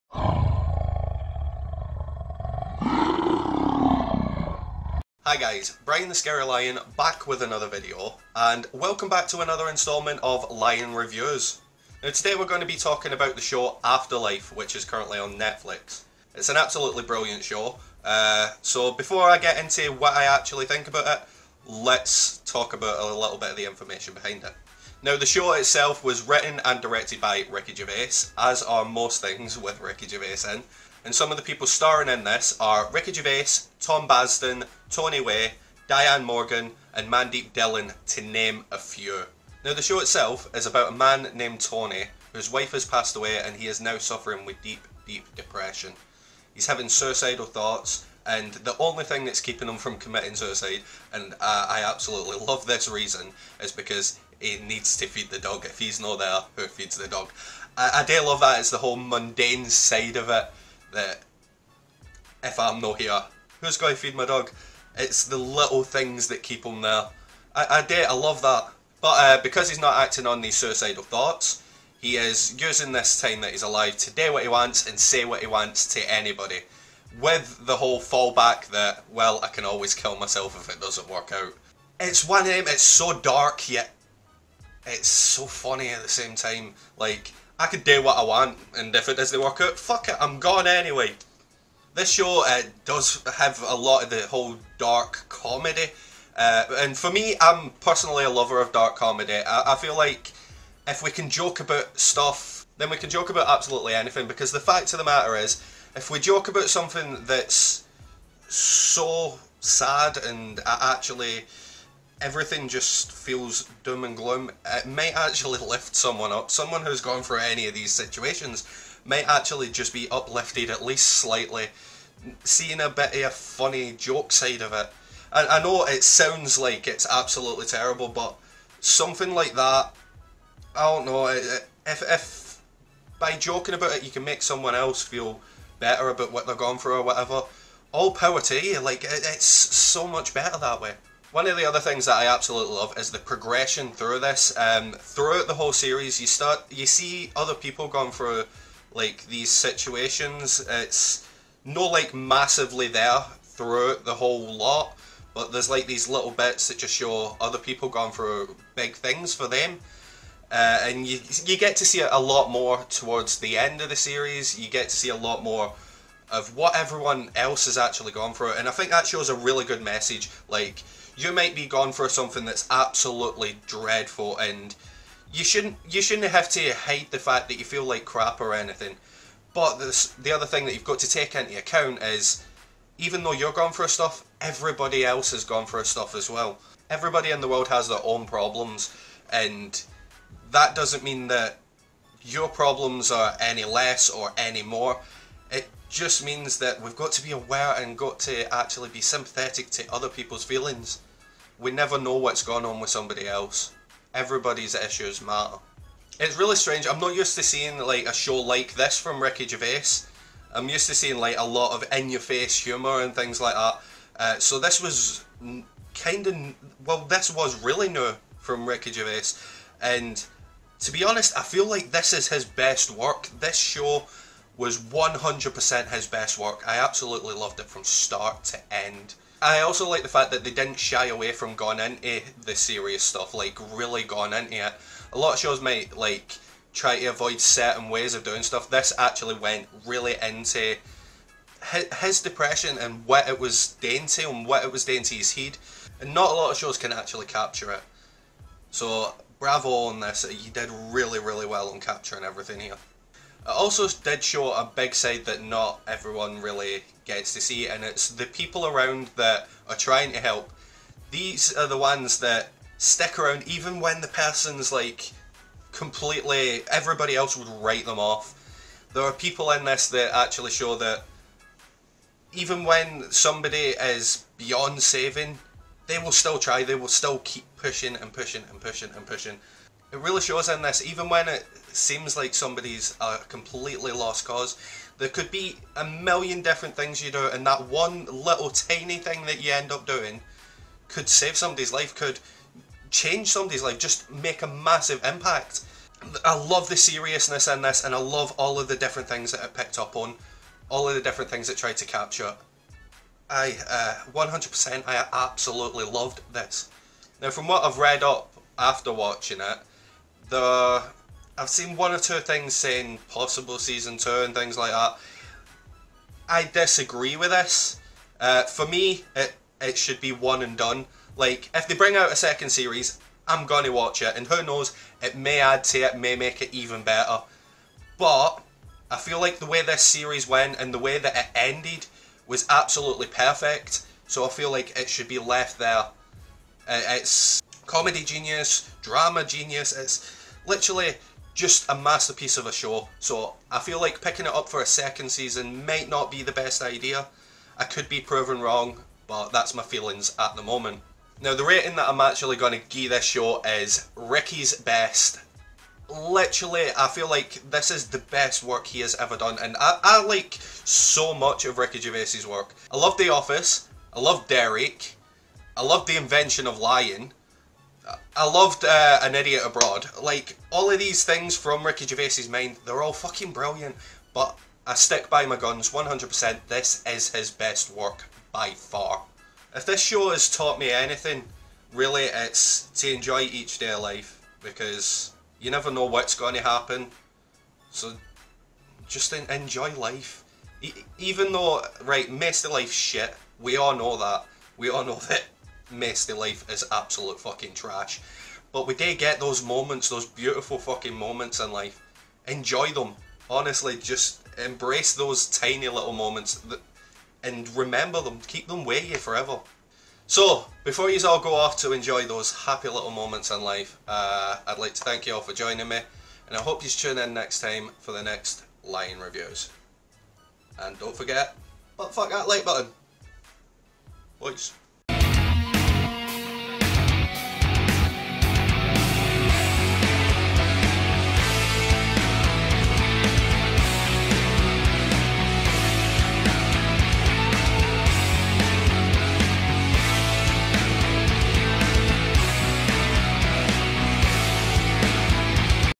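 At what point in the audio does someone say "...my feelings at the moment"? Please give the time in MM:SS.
05:49.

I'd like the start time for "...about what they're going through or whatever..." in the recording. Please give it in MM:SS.
02:16.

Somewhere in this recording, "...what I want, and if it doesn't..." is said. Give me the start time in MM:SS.
01:28.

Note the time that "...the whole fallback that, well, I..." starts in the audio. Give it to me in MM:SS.
01:17.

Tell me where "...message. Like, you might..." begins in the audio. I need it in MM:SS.
02:49.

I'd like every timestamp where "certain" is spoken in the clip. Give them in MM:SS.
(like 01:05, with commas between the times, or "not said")
03:57.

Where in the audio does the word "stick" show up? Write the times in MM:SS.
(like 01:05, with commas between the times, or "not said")
04:22, 06:14.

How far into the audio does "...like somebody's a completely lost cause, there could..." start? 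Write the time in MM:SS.
04:42.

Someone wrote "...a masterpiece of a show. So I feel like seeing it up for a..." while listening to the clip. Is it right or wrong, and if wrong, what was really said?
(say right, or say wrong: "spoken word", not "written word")
wrong: "picking", not "seeing".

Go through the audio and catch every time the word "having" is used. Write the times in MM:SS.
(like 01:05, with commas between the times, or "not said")
00:46.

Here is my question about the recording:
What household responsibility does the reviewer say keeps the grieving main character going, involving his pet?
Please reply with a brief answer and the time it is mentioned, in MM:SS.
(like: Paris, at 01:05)
Feed the dog, at 00:55.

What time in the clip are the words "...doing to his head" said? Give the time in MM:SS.
04:04.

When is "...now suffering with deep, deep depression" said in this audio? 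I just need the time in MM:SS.
00:43.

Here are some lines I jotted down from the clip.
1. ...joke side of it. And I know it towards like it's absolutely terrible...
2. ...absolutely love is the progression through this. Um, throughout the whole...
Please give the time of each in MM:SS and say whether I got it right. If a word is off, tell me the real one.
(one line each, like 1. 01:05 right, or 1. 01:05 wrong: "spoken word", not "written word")
1. 02:03 wrong: "sounds", not "towards"
2. 02:22 right.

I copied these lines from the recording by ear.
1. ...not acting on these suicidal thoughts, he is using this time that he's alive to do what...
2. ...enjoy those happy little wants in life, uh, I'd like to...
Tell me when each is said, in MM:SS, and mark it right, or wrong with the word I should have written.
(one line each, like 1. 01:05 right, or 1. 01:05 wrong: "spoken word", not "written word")
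1. 01:09 right
2. 06:51 wrong: "moments", not "wants".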